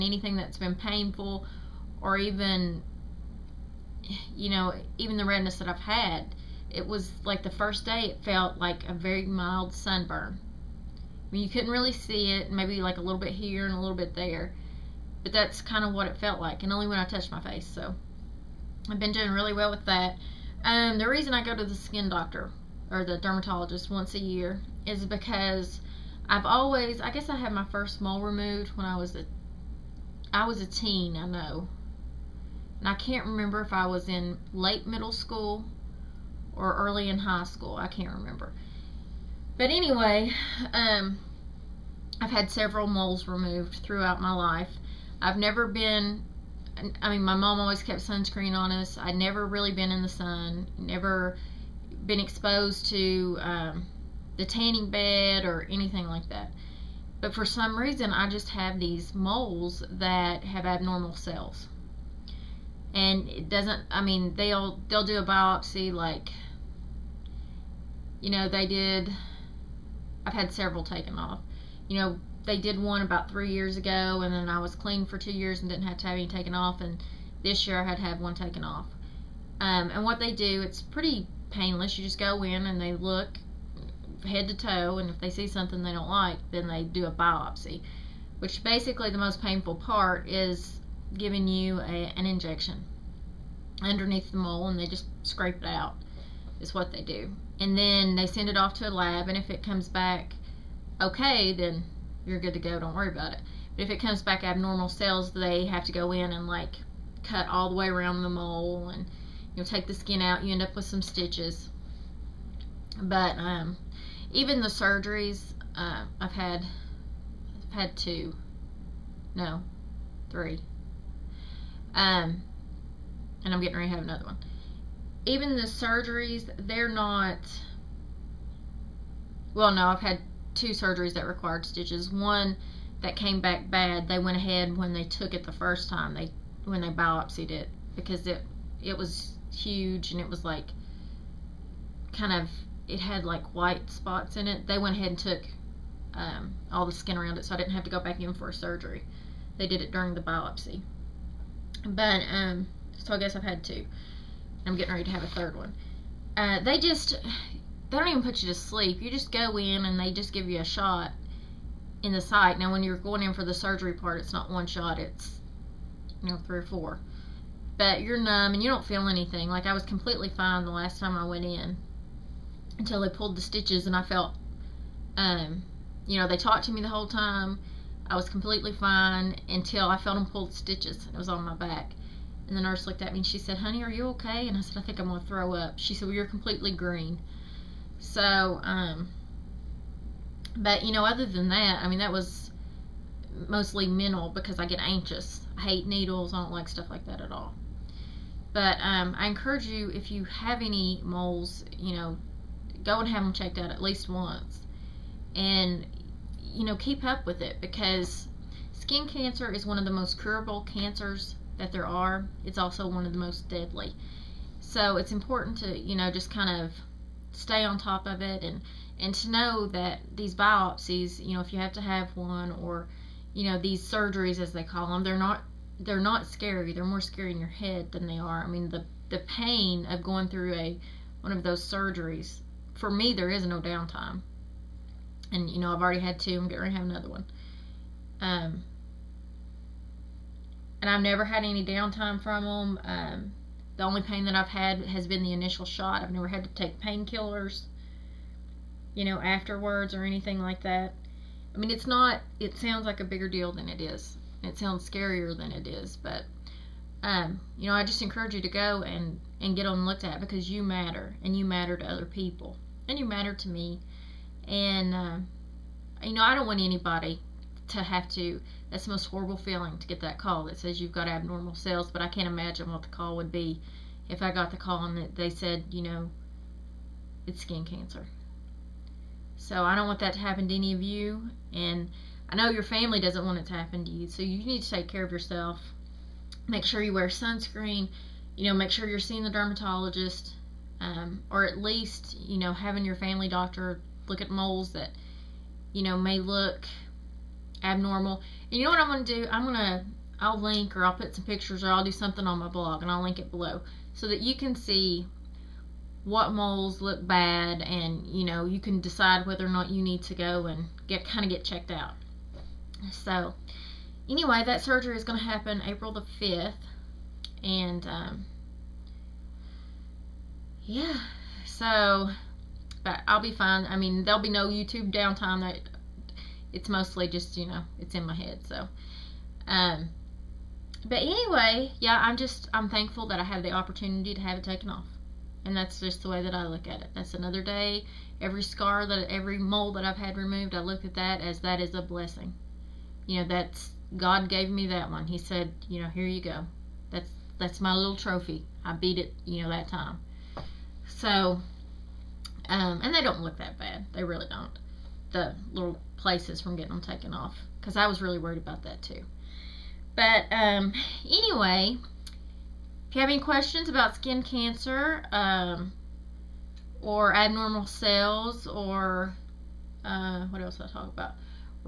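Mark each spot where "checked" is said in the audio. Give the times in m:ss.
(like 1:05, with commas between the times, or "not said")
3:23, 5:11.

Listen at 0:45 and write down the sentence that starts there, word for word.
I've never been, I mean, my mom always kept sunscreen on us.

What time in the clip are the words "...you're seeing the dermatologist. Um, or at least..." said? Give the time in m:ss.
4:48.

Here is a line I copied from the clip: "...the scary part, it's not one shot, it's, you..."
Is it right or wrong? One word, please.
wrong.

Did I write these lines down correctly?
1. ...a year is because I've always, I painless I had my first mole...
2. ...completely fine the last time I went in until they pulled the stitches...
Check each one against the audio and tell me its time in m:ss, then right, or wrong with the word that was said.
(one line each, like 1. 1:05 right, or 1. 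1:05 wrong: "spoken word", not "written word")
1. 0:24 wrong: "guess", not "painless"
2. 2:49 right.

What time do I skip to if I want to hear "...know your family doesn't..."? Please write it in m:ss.
4:42.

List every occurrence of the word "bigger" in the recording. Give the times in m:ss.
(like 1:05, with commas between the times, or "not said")
4:13.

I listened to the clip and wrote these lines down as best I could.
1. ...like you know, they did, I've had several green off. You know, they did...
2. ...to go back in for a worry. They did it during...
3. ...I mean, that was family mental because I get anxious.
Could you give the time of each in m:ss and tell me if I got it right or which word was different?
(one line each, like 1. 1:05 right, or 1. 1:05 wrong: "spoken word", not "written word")
1. 1:05 wrong: "taken", not "green"
2. 2:27 wrong: "surgery", not "worry"
3. 3:11 wrong: "mostly", not "family".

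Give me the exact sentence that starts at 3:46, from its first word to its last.
They're more scary in your head than they are.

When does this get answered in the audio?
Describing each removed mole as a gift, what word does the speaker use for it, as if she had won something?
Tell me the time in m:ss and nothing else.
5:47.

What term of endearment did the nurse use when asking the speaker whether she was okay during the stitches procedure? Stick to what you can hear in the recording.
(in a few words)
Honey.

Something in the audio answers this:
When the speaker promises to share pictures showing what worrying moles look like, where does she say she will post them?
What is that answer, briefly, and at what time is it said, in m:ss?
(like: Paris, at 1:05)
blog, at 5:02.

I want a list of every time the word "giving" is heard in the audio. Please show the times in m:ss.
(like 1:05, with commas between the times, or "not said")
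1:31.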